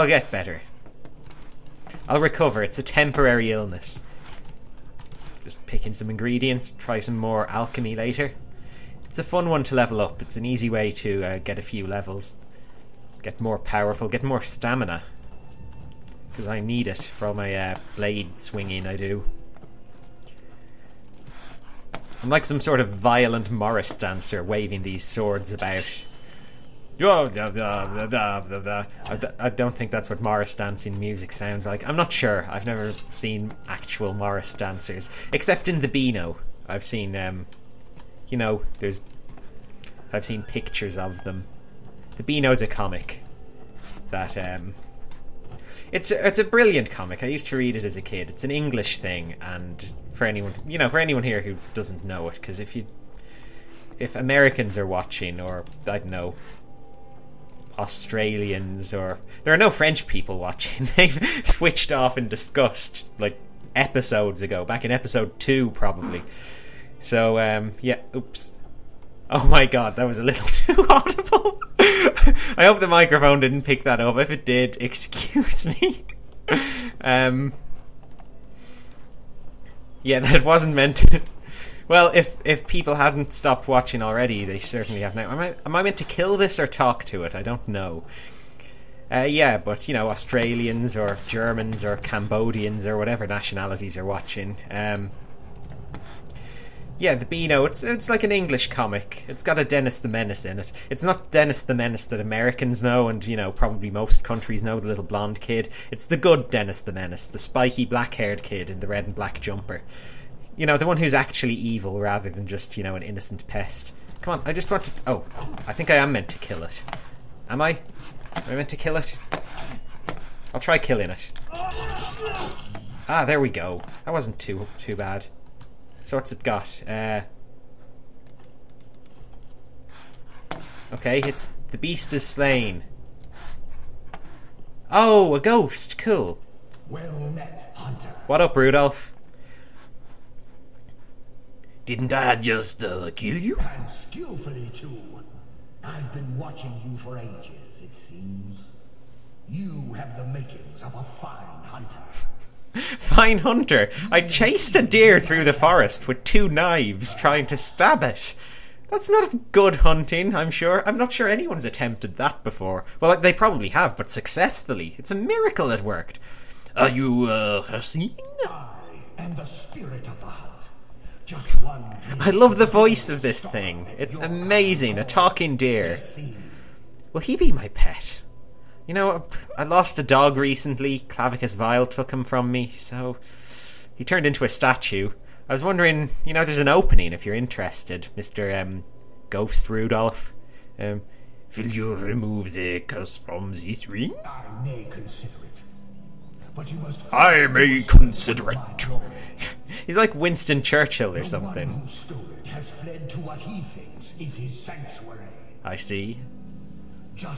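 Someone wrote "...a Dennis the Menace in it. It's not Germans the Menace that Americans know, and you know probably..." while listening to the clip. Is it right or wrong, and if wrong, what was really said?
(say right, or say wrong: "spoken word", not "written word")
wrong: "Dennis", not "Germans".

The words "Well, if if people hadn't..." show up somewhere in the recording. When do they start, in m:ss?
1:21.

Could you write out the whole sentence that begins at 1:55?
Oh, I think I am meant to kill it.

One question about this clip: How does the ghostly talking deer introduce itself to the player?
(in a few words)
the spirit of the hunt.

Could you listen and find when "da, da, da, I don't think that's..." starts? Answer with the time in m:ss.
0:26.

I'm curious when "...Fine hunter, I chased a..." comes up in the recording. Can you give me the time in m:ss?
2:32.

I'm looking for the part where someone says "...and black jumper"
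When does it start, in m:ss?
1:49.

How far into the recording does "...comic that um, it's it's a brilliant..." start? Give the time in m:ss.
0:42.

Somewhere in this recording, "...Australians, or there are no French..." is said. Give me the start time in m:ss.
0:57.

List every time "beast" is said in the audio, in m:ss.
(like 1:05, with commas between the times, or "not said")
2:11.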